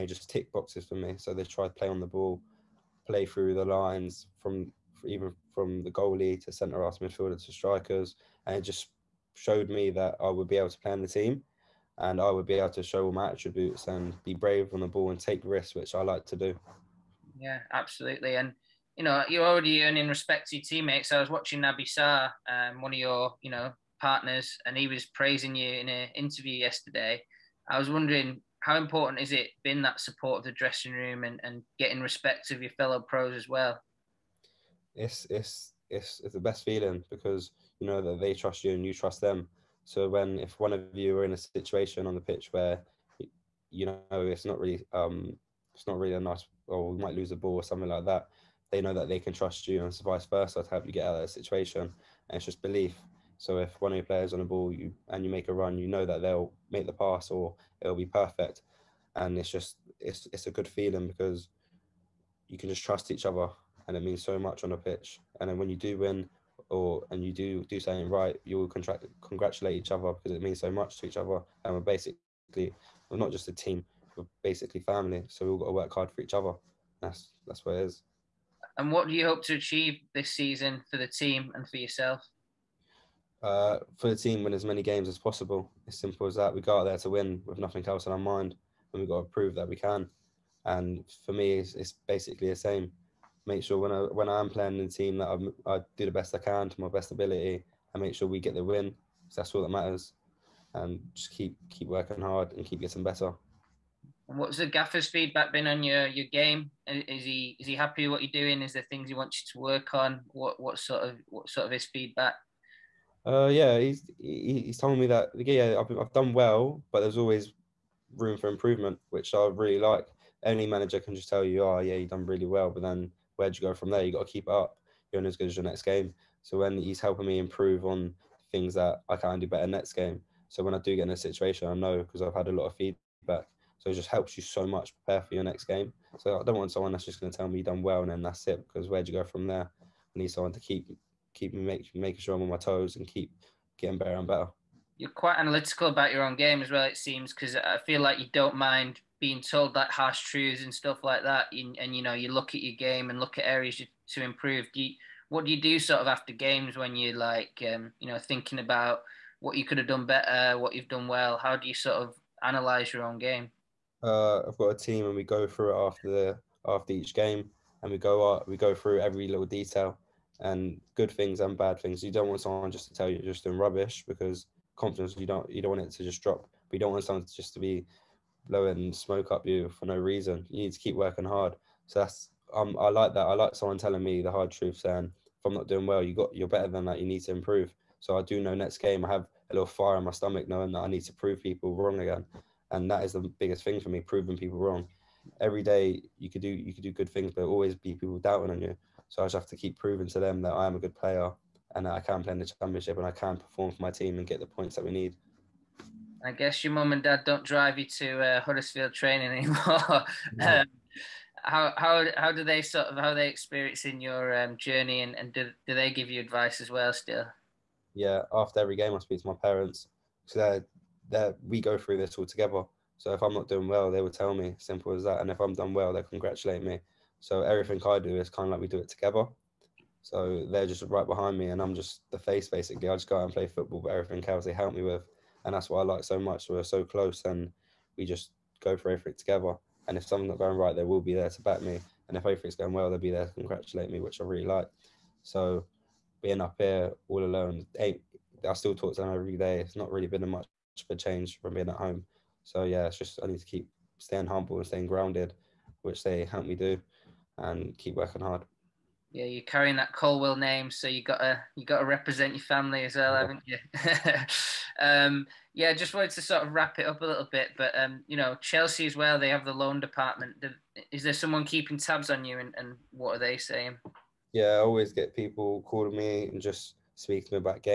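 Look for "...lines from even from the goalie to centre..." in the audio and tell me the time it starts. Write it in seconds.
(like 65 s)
3 s.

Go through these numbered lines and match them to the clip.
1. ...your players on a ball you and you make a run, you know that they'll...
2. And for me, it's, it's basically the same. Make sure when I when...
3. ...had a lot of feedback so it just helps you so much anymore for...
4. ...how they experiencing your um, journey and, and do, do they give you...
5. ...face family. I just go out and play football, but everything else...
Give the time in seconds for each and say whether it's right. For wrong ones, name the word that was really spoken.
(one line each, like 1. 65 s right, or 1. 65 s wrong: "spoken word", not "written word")
1. 53 s right
2. 90 s right
3. 132 s wrong: "prepare", not "anymore"
4. 212 s right
5. 232 s wrong: "basically", not "family".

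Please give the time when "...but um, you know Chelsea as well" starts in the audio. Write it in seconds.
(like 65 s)
267 s.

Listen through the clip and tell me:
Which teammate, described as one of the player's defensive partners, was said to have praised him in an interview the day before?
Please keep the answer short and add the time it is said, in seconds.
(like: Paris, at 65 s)
Naby Sarr, at 21 s.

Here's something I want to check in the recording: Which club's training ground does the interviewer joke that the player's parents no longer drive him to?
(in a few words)
Huddersfield.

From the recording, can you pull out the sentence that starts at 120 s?
Any manager can just tell you, oh yeah, you've done really well, but then where'd you go from there?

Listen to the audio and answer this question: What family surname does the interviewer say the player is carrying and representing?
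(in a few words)
Colwill.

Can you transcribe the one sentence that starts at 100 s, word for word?
And just keep keep working hard and keep getting better.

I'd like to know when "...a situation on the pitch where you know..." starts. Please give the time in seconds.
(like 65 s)
41 s.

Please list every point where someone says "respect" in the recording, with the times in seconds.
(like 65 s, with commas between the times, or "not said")
20 s, 32 s.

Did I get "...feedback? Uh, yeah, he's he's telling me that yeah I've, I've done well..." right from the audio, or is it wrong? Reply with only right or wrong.
right.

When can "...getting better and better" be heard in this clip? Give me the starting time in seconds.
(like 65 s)
143 s.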